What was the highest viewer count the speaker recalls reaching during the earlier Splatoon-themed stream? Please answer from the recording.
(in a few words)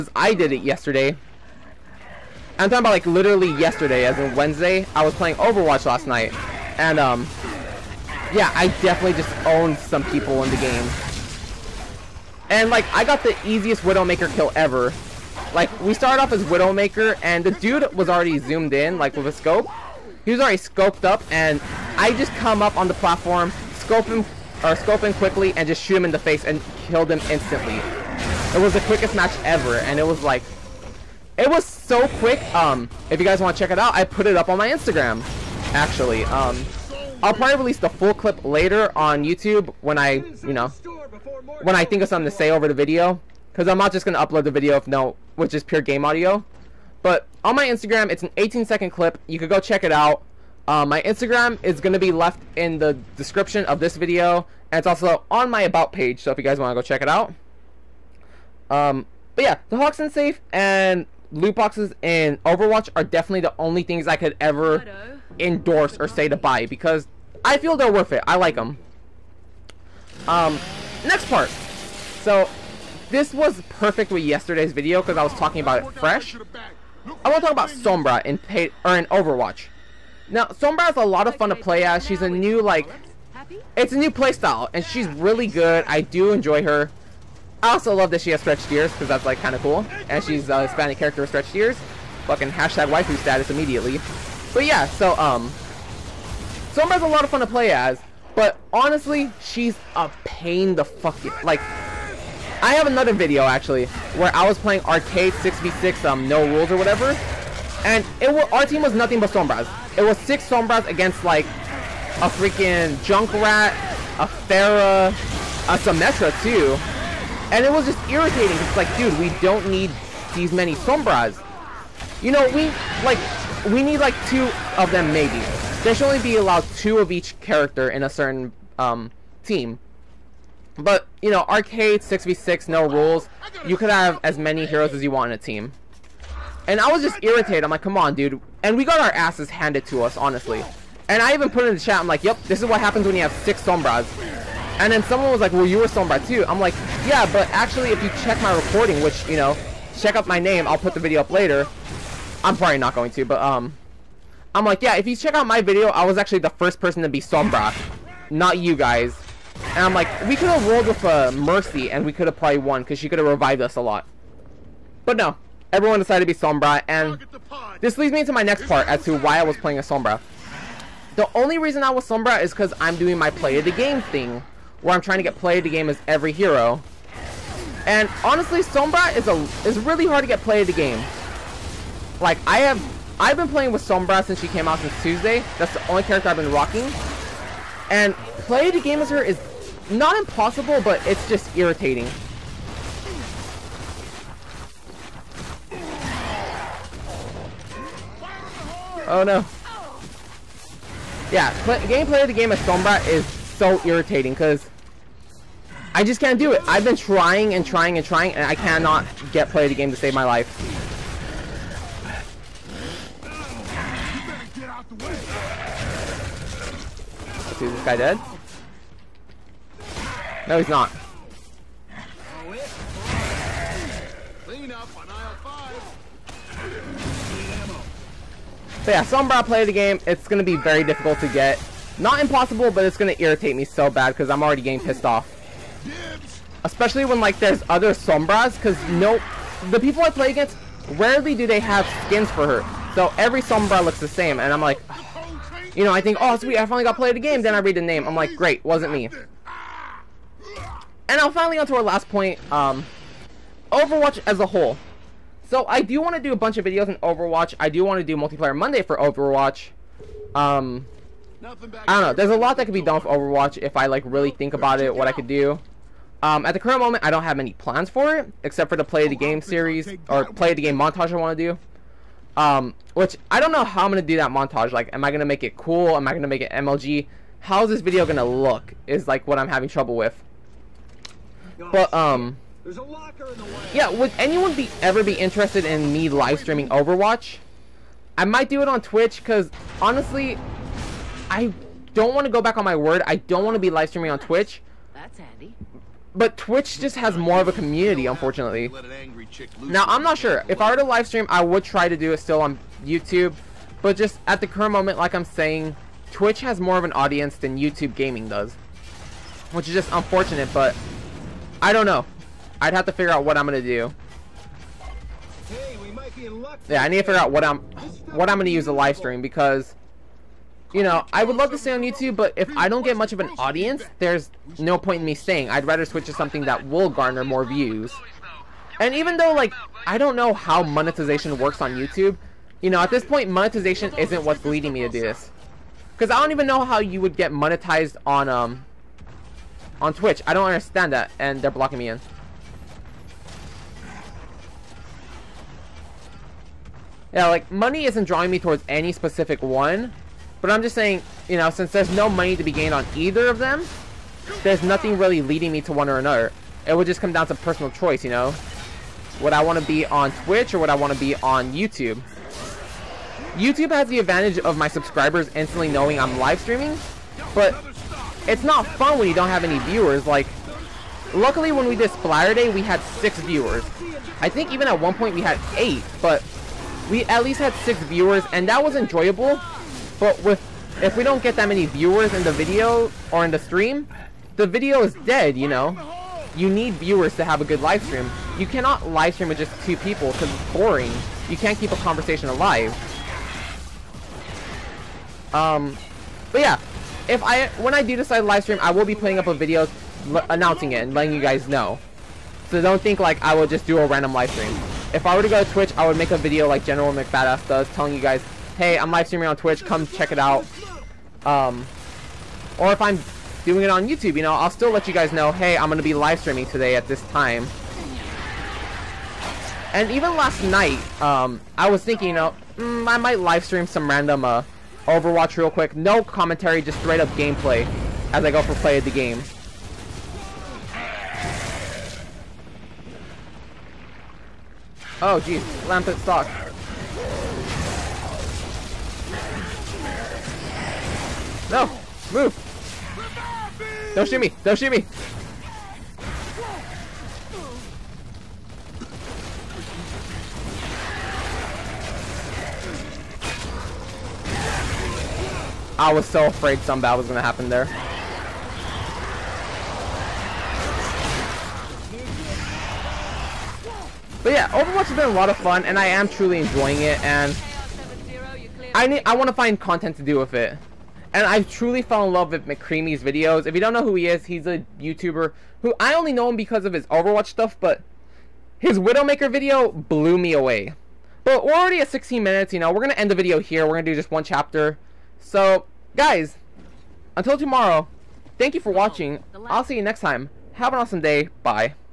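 8.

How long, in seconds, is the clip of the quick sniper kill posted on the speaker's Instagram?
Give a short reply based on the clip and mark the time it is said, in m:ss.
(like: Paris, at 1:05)
18, at 0:48.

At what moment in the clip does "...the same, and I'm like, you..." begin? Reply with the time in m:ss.
4:04.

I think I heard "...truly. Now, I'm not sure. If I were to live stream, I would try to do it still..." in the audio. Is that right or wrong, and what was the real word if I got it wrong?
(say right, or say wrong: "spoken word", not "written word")
wrong: "unfortunately", not "truly".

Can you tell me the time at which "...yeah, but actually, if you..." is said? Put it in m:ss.
2:27.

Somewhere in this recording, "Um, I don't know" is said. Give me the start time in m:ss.
4:20.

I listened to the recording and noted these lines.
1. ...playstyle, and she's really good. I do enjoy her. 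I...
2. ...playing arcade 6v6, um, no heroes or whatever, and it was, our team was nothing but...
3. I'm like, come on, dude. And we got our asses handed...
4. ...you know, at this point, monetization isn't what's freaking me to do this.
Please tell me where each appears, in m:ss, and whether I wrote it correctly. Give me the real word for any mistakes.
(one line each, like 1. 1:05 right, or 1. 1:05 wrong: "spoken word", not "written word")
1. 1:24 right
2. 1:44 wrong: "rules", not "heroes"
3. 2:17 right
4. 5:32 wrong: "leading", not "freaking".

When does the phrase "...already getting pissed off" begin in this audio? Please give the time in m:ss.
3:54.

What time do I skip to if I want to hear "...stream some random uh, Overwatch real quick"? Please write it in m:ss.
7:03.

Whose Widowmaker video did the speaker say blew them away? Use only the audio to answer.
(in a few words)
McCreamy.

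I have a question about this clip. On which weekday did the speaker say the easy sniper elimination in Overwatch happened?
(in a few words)
Wednesday.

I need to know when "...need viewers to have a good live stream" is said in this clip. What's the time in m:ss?
6:26.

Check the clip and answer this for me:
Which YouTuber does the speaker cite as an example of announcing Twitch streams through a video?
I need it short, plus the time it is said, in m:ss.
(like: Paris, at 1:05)
General McBadass, at 6:46.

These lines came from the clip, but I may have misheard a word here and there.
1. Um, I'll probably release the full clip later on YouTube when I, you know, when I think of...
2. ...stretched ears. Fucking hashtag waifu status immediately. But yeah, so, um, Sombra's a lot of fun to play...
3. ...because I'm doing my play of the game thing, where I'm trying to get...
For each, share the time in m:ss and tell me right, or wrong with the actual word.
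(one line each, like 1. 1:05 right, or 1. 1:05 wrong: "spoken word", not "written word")
1. 0:36 right
2. 1:31 right
3. 2:52 right.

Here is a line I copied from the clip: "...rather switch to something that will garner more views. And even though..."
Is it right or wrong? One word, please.
right.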